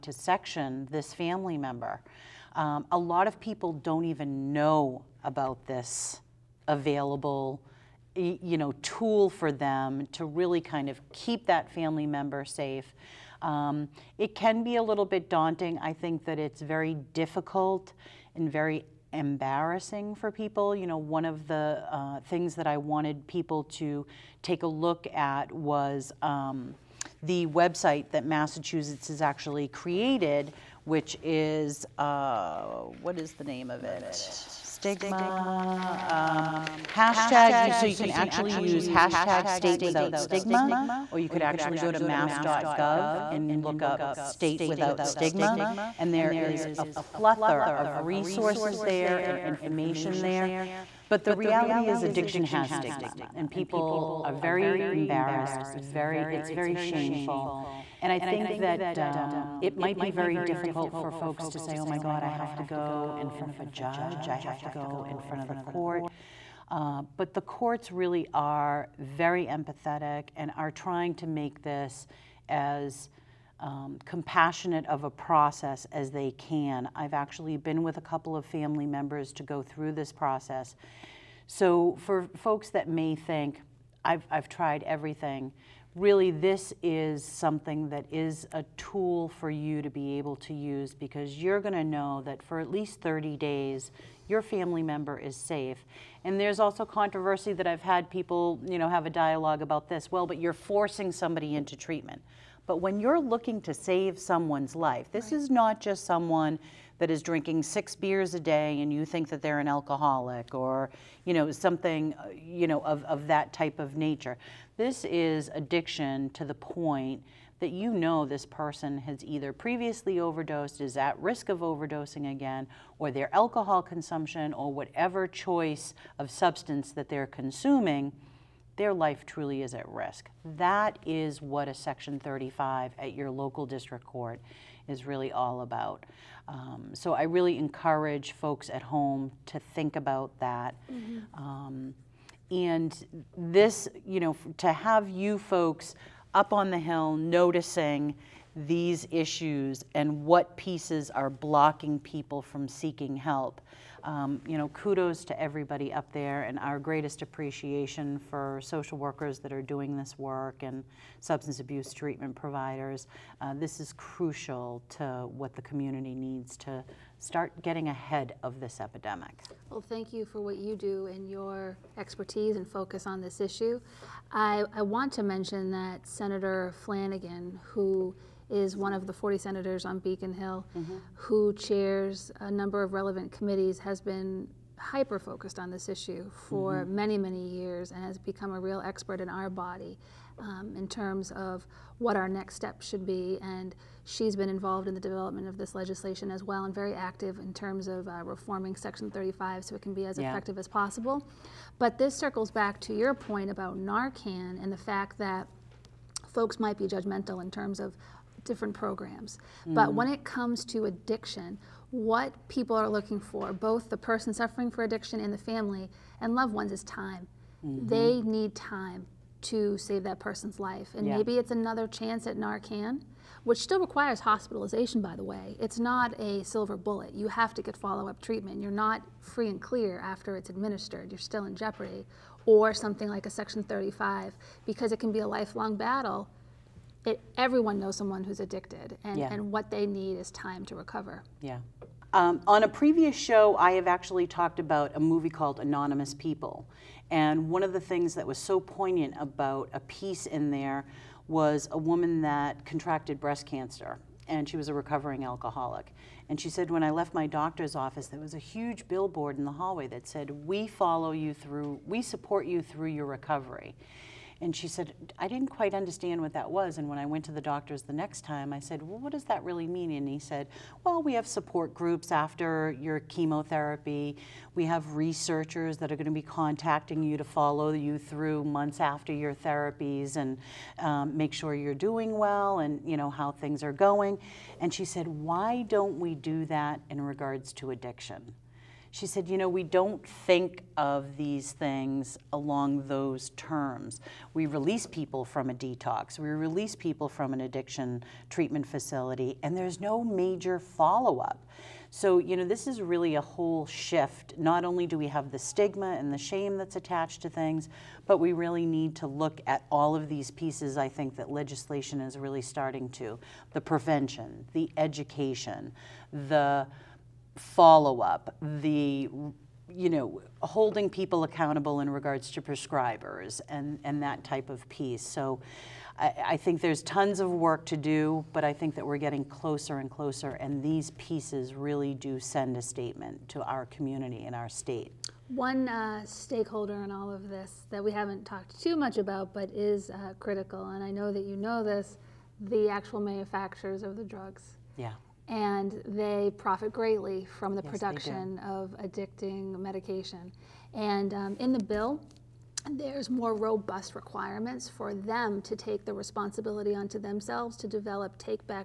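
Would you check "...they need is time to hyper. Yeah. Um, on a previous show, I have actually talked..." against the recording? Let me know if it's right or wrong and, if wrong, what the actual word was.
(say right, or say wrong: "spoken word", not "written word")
wrong: "recover", not "hyper".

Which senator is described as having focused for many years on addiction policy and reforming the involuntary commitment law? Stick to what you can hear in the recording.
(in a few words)
Senator Flanagan.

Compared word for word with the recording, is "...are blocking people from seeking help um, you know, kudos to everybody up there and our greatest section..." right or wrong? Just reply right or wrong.
wrong.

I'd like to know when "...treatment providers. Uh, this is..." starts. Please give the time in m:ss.
2:41.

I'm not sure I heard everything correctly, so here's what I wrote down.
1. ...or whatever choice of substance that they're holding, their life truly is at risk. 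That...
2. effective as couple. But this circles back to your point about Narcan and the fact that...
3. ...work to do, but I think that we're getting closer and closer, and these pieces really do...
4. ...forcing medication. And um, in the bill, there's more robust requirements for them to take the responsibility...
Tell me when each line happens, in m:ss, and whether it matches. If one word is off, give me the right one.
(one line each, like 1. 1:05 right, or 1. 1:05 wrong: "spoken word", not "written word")
1. 2:04 wrong: "consuming", not "holding"
2. 3:20 wrong: "possible", not "couple"
3. 5:27 right
4. 5:48 wrong: "addicting", not "forcing".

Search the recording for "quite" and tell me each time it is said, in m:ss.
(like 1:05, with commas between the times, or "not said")
4:25.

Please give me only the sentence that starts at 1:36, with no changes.
And there's also controversy that I've had people, you know, have a dialogue about this.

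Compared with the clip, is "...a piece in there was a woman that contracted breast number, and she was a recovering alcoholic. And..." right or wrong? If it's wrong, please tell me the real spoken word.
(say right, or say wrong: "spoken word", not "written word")
wrong: "cancer", not "number".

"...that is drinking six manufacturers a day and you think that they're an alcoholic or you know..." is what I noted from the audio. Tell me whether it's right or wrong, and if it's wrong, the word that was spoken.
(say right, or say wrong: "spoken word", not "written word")
wrong: "beers", not "manufacturers".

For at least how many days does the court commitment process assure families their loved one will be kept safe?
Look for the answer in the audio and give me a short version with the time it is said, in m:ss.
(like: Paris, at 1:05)
30, at 1:33.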